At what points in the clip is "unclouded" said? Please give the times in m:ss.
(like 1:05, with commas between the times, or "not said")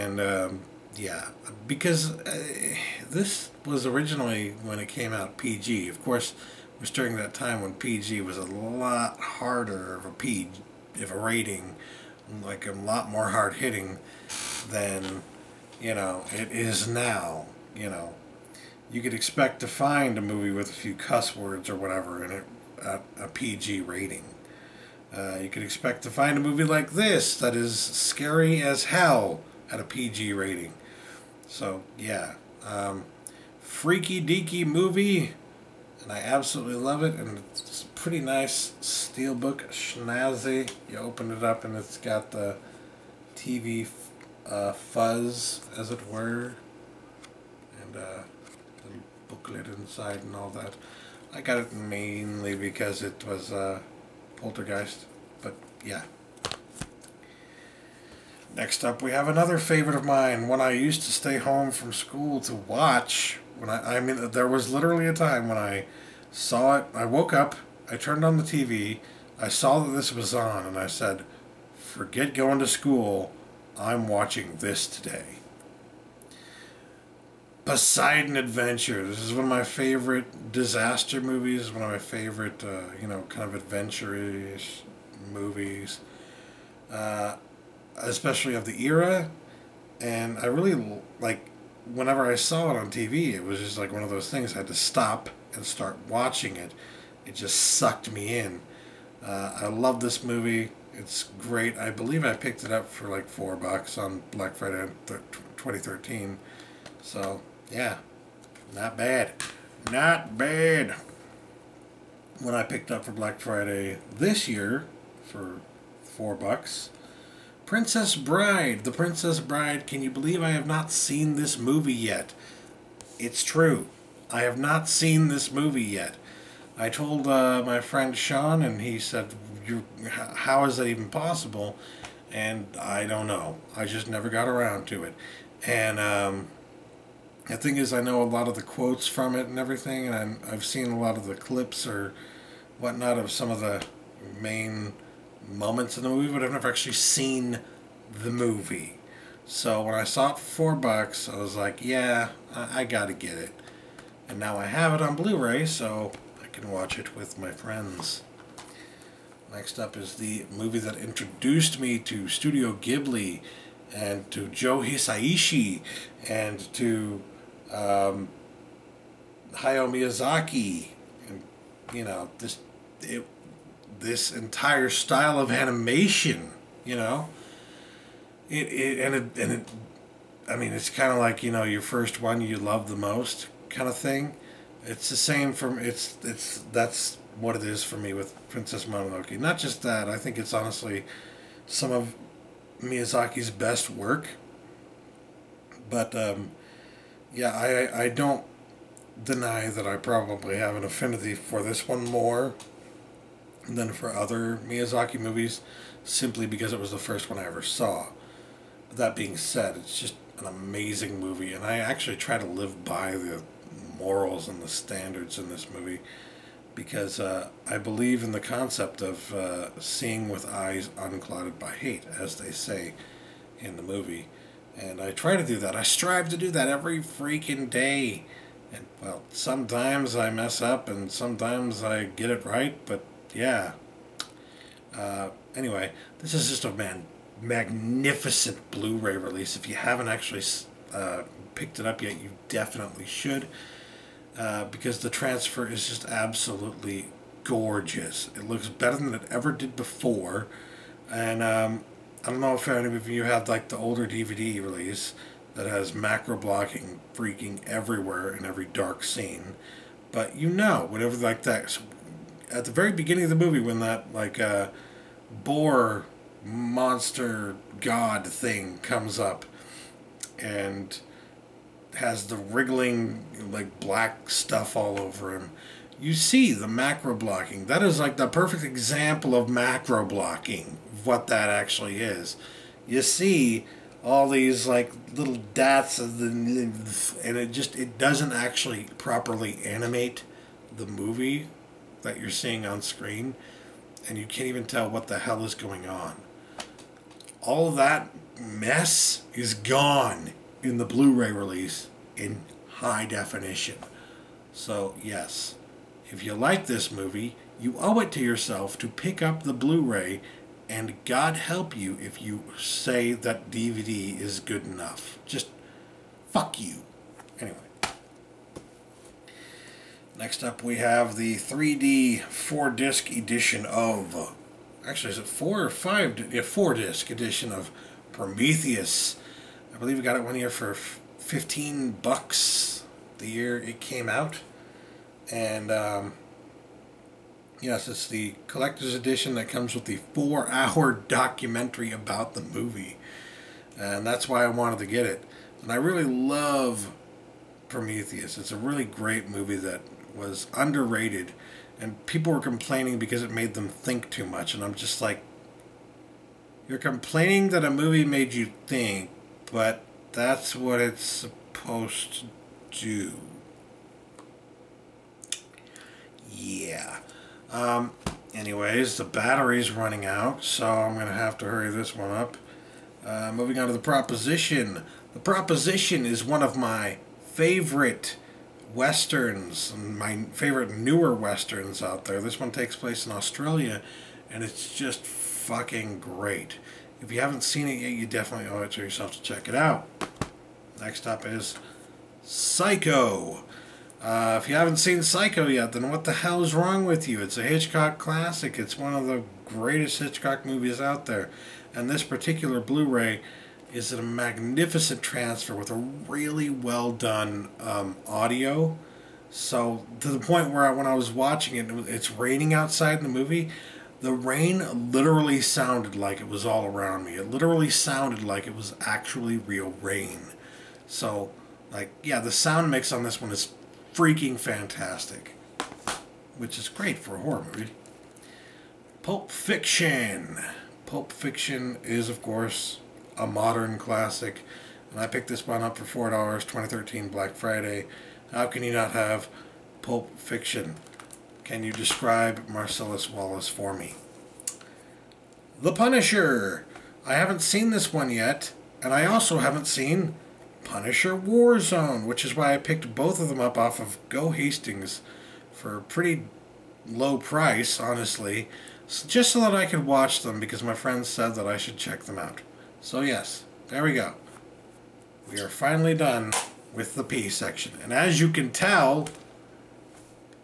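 3:40.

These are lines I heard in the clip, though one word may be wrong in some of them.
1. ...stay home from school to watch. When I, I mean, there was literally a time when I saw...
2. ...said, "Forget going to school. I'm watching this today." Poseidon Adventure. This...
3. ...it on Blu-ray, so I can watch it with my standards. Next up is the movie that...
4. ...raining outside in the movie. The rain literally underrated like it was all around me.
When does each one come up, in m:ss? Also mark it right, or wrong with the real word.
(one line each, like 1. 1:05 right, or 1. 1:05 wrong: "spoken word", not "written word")
1. 1:01 right
2. 1:10 right
3. 2:34 wrong: "friends", not "standards"
4. 6:52 wrong: "sounded", not "underrated".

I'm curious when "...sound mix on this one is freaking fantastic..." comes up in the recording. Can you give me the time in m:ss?
7:02.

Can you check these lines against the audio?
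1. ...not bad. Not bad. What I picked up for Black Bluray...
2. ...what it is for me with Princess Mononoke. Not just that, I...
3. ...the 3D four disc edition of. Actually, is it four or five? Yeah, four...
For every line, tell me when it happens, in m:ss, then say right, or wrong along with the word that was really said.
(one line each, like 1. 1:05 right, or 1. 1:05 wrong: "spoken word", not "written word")
1. 1:48 wrong: "Friday", not "Bluray"
2. 3:07 right
3. 5:21 right.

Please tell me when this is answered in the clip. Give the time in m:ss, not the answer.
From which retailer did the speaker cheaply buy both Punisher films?
7:34.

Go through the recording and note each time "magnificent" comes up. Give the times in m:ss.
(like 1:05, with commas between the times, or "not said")
3:57, 6:44.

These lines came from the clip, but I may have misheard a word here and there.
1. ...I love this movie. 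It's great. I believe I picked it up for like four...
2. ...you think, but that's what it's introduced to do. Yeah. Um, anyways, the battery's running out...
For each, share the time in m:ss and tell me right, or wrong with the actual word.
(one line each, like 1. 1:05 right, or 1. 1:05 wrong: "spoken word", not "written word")
1. 1:39 right
2. 5:58 wrong: "supposed", not "introduced".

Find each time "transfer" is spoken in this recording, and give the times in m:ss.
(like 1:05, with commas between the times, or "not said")
4:05, 6:45.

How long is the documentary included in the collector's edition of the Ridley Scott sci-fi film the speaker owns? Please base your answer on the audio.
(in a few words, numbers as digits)
4 hours.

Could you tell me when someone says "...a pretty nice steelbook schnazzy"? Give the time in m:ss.
0:37.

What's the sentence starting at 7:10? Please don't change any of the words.
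Pulp Fiction is, of course, a modern classic, and I picked this one up for $4, 2013 Black Friday.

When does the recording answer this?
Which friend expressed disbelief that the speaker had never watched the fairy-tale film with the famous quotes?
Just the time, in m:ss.
2:08.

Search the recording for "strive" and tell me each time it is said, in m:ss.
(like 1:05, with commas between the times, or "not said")
3:45.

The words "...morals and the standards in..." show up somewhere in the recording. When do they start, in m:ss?
3:33.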